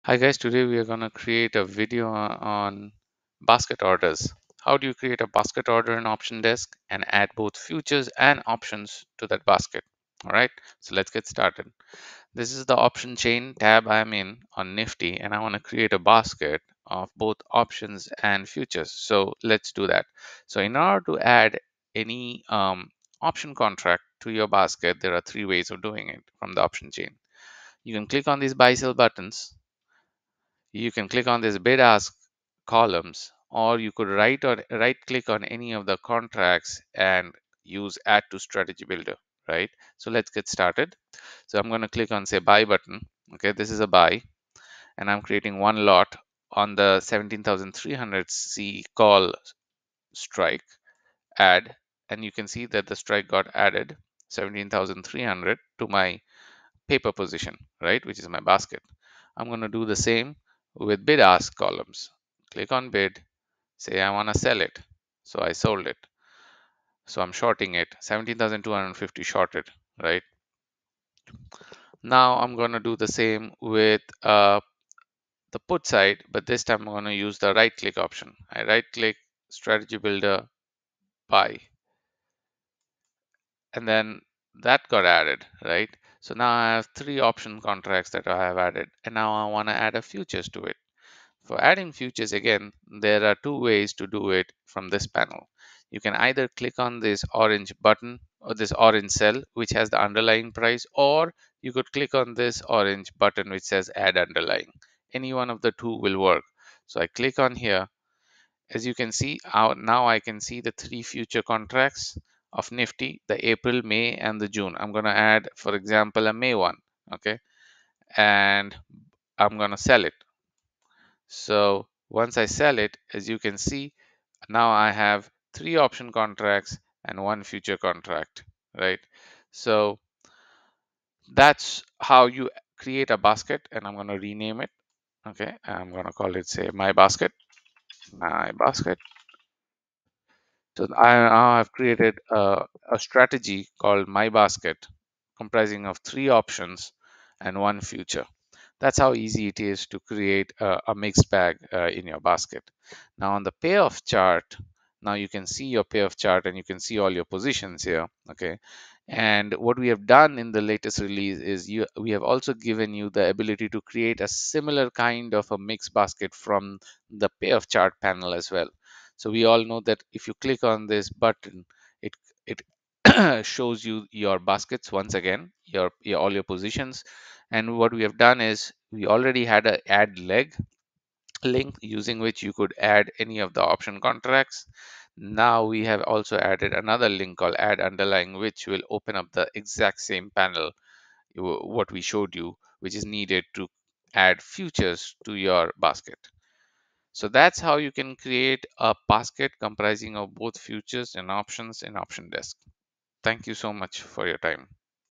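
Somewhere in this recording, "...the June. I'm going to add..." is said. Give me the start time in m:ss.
1:54.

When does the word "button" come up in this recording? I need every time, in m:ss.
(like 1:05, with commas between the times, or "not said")
0:28, 0:42, 1:37, 1:43, 2:51.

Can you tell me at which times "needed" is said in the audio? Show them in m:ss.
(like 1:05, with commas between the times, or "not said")
3:13.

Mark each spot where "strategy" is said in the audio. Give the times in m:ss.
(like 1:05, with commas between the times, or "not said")
0:38, 1:19, 2:22.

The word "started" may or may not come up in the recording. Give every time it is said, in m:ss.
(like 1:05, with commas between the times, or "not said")
0:11, 0:40.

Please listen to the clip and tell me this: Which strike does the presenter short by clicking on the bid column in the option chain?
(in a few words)
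17,250.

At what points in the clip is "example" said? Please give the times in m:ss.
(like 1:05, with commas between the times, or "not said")
1:55.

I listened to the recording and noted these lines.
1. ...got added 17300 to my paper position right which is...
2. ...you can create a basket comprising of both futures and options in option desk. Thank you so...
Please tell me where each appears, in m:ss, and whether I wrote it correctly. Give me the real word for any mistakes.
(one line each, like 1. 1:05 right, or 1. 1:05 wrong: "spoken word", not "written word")
1. 0:53 right
2. 3:17 right.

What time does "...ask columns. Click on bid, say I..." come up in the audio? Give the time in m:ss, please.
1:01.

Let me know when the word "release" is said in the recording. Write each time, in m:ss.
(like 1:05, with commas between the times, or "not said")
2:40.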